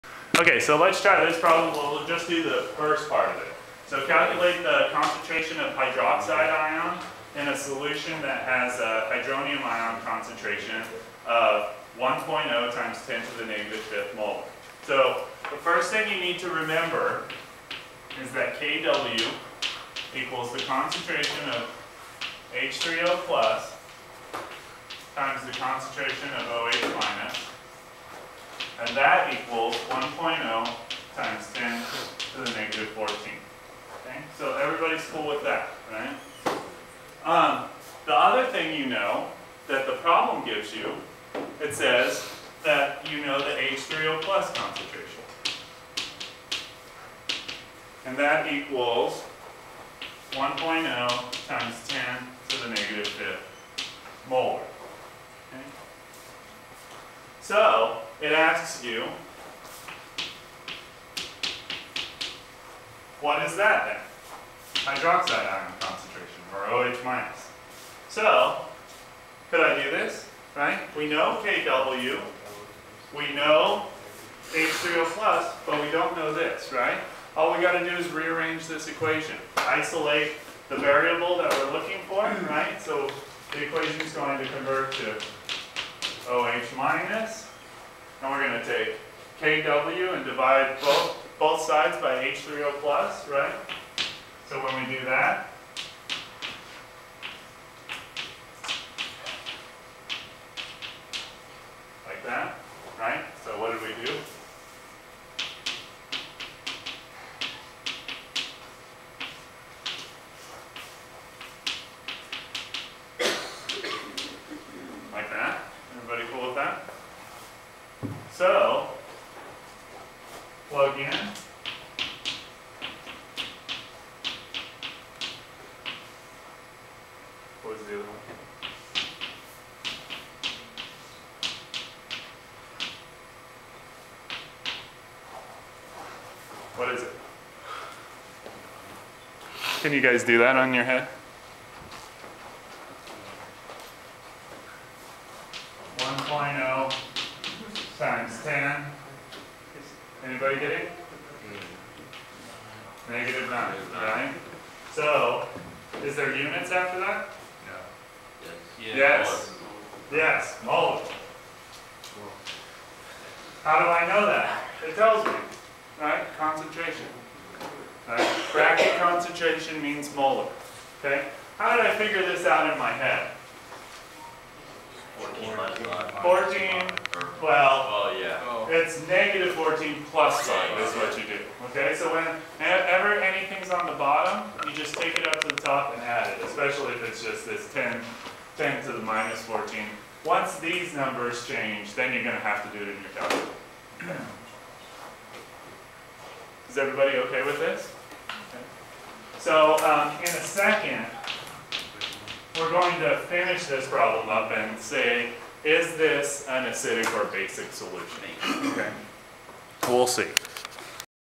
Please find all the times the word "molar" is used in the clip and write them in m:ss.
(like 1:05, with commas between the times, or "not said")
0:54, 2:40, 2:50.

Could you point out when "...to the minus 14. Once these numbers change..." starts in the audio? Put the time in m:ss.
3:08.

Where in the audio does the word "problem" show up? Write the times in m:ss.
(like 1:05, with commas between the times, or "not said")
0:01, 0:39, 3:23.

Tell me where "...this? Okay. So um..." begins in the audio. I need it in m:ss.
3:17.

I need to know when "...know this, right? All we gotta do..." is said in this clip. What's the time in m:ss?
1:16.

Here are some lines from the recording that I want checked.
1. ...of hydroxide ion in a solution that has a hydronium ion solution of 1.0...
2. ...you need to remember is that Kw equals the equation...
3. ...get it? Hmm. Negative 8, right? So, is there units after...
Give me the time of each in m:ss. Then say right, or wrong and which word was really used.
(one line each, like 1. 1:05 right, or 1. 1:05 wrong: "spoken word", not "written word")
1. 0:05 wrong: "concentration", not "solution"
2. 0:16 wrong: "concentration", not "equation"
3. 2:30 wrong: "9", not "8".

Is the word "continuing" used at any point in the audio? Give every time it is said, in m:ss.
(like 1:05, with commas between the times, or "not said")
not said.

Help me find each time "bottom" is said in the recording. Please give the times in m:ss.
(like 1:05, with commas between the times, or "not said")
3:03.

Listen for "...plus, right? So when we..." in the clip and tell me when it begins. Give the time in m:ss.
1:32.